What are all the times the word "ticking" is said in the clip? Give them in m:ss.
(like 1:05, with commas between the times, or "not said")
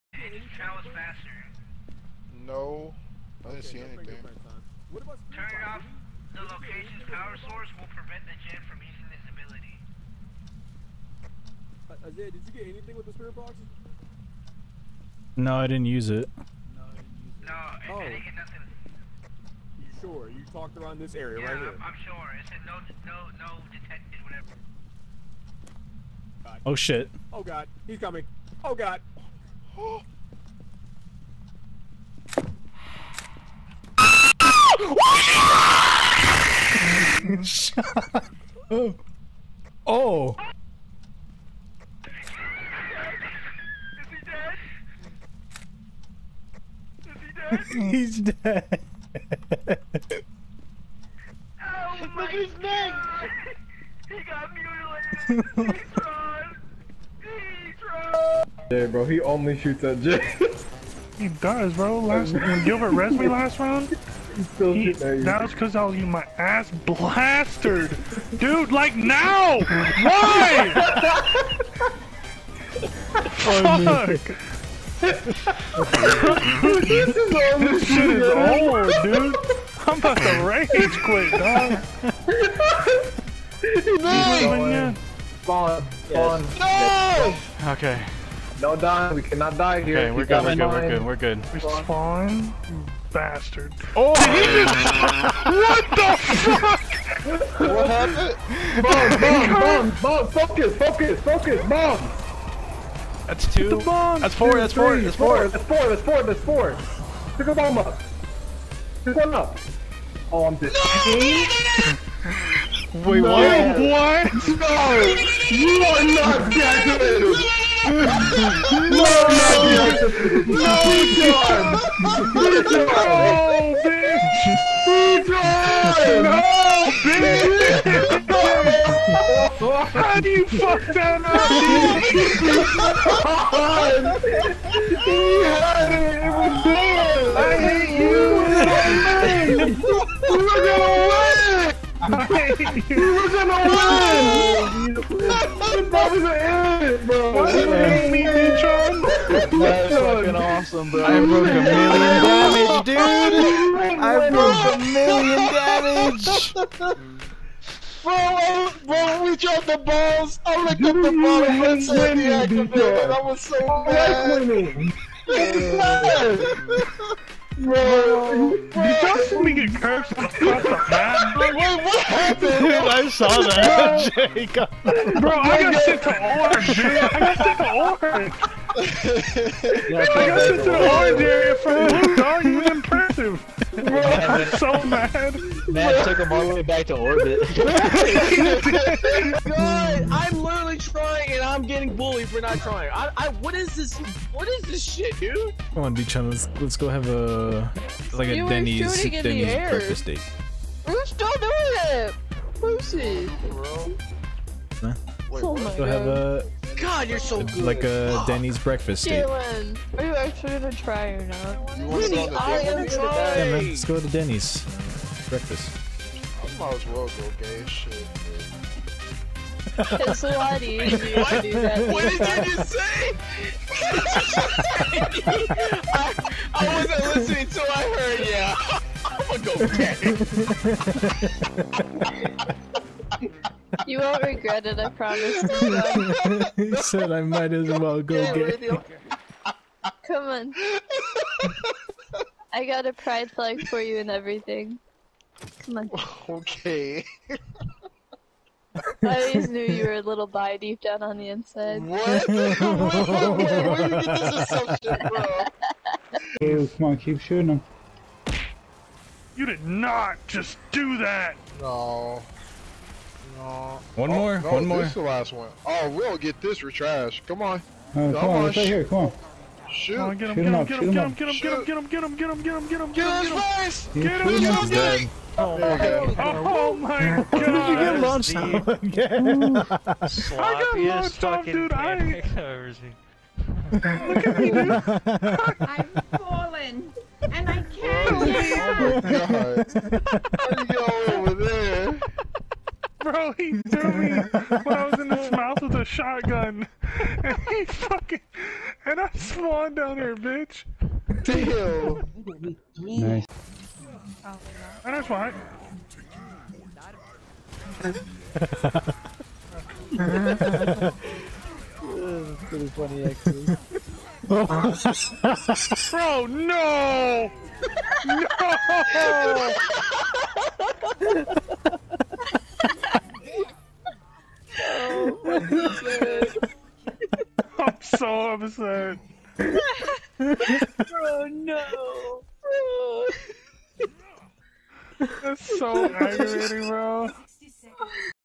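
not said.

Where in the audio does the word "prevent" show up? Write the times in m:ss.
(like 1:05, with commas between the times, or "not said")
0:07.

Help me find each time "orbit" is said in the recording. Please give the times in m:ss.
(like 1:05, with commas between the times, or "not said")
3:06.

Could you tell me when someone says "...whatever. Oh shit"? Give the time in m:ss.
0:24.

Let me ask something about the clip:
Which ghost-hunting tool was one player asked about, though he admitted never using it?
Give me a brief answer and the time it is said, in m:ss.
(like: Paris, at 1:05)
spirit box, at 0:13.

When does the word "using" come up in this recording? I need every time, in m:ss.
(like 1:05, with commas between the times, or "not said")
0:08.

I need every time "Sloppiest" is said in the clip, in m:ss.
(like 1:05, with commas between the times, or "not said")
4:40.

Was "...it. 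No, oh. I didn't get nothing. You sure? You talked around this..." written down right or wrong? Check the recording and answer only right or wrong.
right.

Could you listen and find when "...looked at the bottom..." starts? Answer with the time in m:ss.
2:40.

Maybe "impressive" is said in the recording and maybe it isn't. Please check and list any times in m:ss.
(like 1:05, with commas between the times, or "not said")
3:02.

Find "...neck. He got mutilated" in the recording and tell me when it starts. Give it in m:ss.
0:52.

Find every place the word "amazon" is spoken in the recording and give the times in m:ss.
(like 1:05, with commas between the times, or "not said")
not said.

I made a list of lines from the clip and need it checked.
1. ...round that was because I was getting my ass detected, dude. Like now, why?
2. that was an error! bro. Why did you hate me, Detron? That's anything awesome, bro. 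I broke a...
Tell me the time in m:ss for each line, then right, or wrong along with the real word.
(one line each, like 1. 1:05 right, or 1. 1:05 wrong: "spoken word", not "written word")
1. 1:03 wrong: "blasted", not "detected"
2. 2:25 wrong: "fucking", not "anything".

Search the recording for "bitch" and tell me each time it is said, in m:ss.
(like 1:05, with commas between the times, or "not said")
2:00, 2:07, 5:00.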